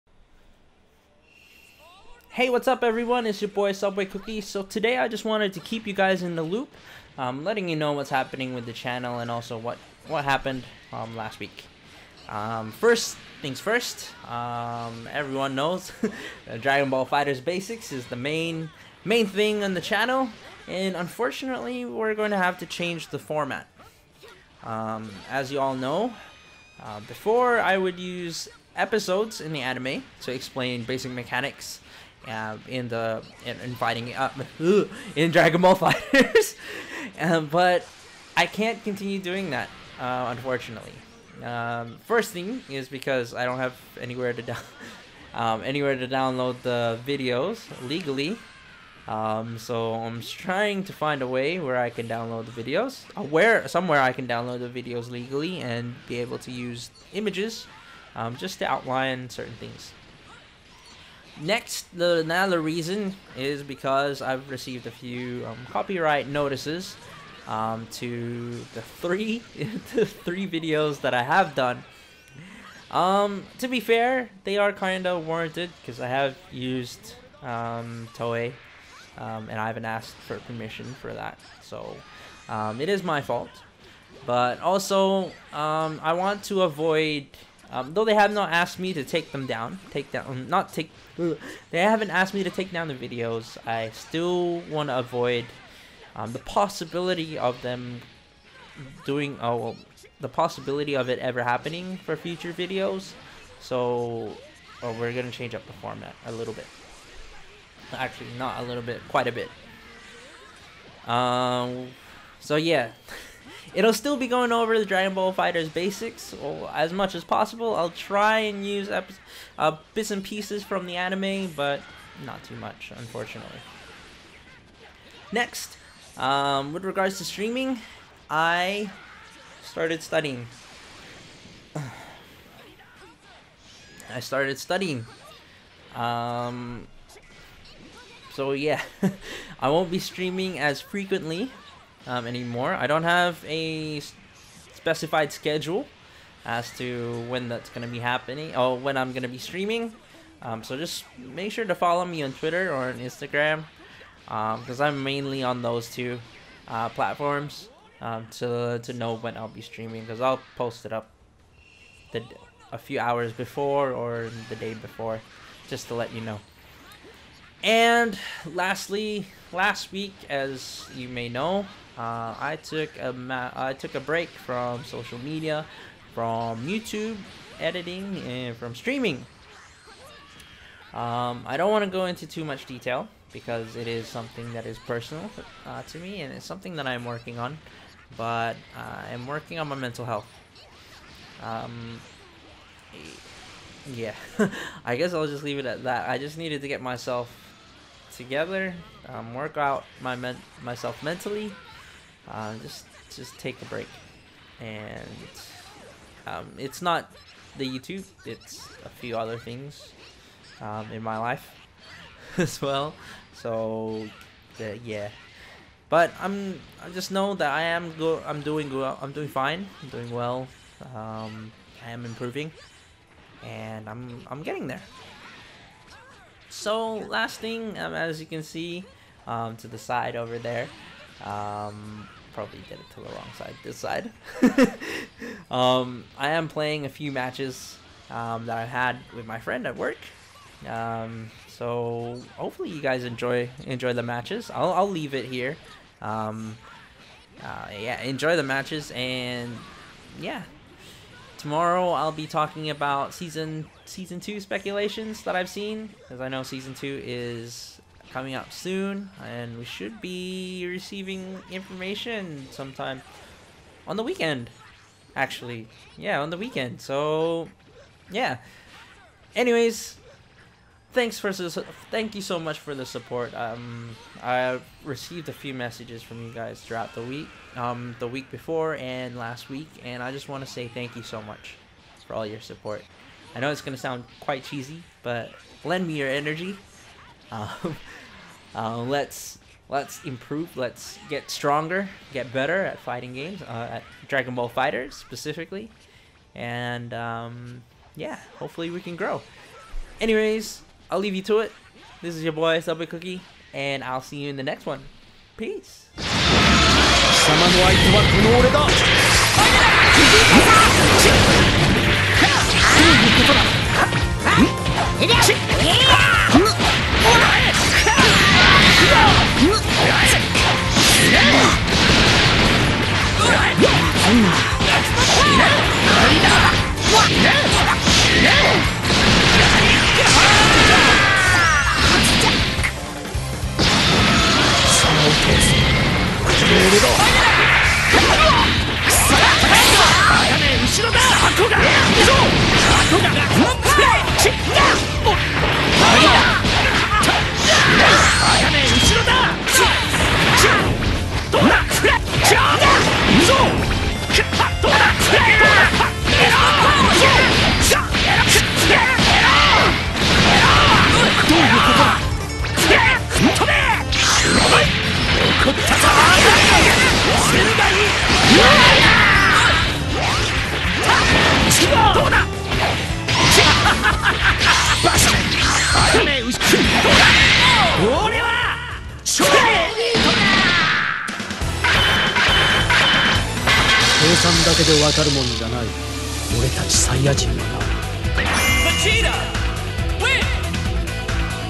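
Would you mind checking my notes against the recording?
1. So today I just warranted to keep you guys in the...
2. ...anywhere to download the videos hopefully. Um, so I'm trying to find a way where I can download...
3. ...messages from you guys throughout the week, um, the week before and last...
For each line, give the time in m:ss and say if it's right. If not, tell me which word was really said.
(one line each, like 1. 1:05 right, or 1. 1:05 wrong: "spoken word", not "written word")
1. 0:04 wrong: "wanted", not "warranted"
2. 0:45 wrong: "legally", not "hopefully"
3. 4:35 right.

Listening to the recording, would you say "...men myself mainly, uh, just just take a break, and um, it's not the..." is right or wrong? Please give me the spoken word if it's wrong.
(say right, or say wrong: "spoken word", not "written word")
wrong: "mentally", not "mainly".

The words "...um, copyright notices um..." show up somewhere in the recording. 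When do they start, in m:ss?
1:05.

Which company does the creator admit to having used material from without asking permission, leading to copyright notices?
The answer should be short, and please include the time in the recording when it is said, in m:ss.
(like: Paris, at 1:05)
Toei, at 1:18.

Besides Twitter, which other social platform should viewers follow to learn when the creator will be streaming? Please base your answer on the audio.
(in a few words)
Instagram.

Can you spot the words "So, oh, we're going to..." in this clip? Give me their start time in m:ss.
1:43.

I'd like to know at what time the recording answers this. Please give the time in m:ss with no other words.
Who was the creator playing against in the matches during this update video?
3:59.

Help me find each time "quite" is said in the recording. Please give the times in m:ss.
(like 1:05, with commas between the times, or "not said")
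1:49, 4:44.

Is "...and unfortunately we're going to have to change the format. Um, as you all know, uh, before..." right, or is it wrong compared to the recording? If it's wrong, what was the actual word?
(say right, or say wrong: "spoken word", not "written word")
right.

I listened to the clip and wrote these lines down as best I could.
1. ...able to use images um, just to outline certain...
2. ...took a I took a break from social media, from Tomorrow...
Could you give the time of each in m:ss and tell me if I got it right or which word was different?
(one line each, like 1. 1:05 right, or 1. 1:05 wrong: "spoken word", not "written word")
1. 0:56 right
2. 2:52 wrong: "YouTube", not "Tomorrow".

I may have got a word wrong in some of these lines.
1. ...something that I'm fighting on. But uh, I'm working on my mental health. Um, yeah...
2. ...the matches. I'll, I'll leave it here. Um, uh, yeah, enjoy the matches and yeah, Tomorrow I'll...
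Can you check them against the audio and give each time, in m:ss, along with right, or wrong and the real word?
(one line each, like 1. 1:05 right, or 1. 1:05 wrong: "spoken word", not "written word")
1. 3:06 wrong: "working", not "fighting"
2. 4:03 right.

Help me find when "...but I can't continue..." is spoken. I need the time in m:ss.
0:37.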